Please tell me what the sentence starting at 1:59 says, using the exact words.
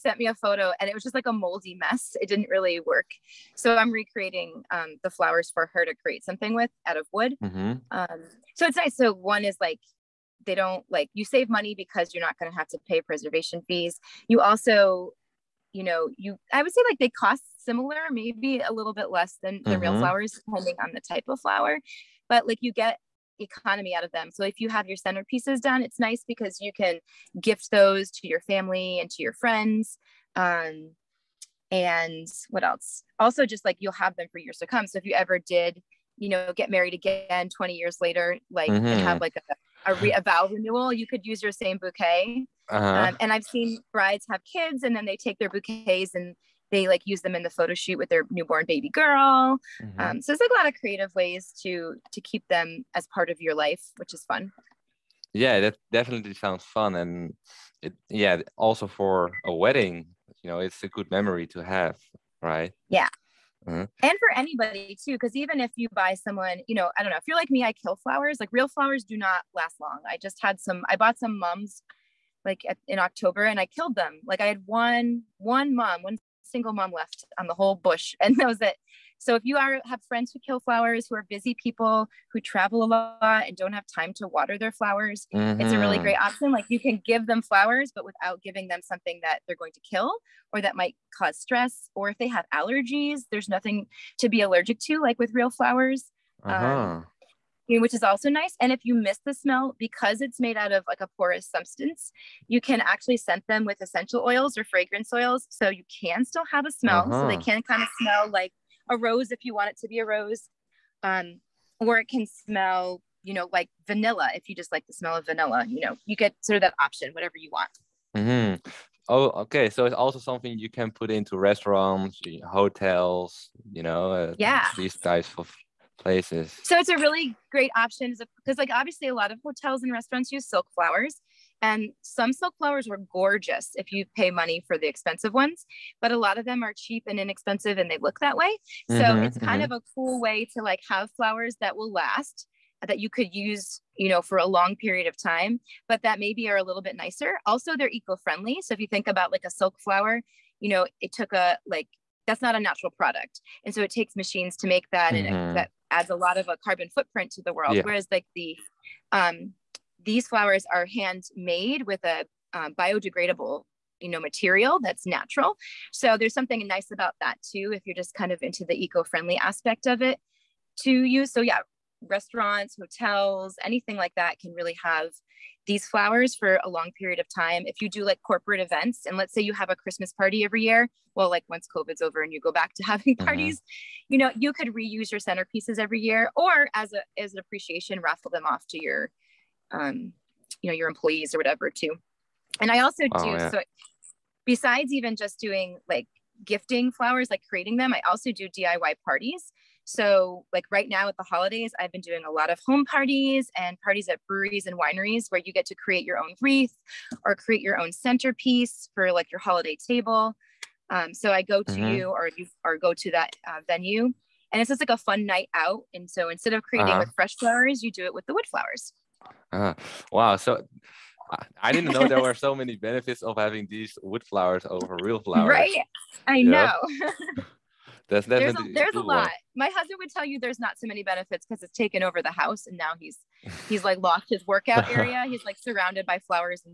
So it's also something you can put into restaurants, hotels, you know, uh, yeah.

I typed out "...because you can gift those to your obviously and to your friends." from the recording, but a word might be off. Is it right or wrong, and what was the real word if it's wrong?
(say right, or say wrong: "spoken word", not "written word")
wrong: "family", not "obviously".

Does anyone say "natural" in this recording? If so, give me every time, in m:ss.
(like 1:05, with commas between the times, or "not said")
2:32, 2:45.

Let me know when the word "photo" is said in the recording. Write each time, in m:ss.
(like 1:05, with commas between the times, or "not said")
0:00, 0:47.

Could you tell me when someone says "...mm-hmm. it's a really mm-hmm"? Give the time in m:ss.
1:25.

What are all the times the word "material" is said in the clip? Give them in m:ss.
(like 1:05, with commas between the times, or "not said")
2:44.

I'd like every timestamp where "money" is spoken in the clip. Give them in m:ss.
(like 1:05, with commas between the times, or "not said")
0:11, 2:14.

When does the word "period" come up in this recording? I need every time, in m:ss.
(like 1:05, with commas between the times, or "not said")
2:24, 2:56.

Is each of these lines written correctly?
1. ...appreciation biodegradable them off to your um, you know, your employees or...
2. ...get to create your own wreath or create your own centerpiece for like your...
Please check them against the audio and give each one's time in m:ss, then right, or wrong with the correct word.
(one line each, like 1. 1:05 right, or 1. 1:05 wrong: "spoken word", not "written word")
1. 3:07 wrong: "raffle", not "biodegradable"
2. 3:25 right.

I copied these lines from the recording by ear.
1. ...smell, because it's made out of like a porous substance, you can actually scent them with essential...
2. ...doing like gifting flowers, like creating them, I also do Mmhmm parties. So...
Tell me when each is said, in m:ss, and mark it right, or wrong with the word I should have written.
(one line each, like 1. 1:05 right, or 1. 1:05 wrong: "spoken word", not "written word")
1. 1:39 right
2. 3:15 wrong: "DIY", not "Mmhmm".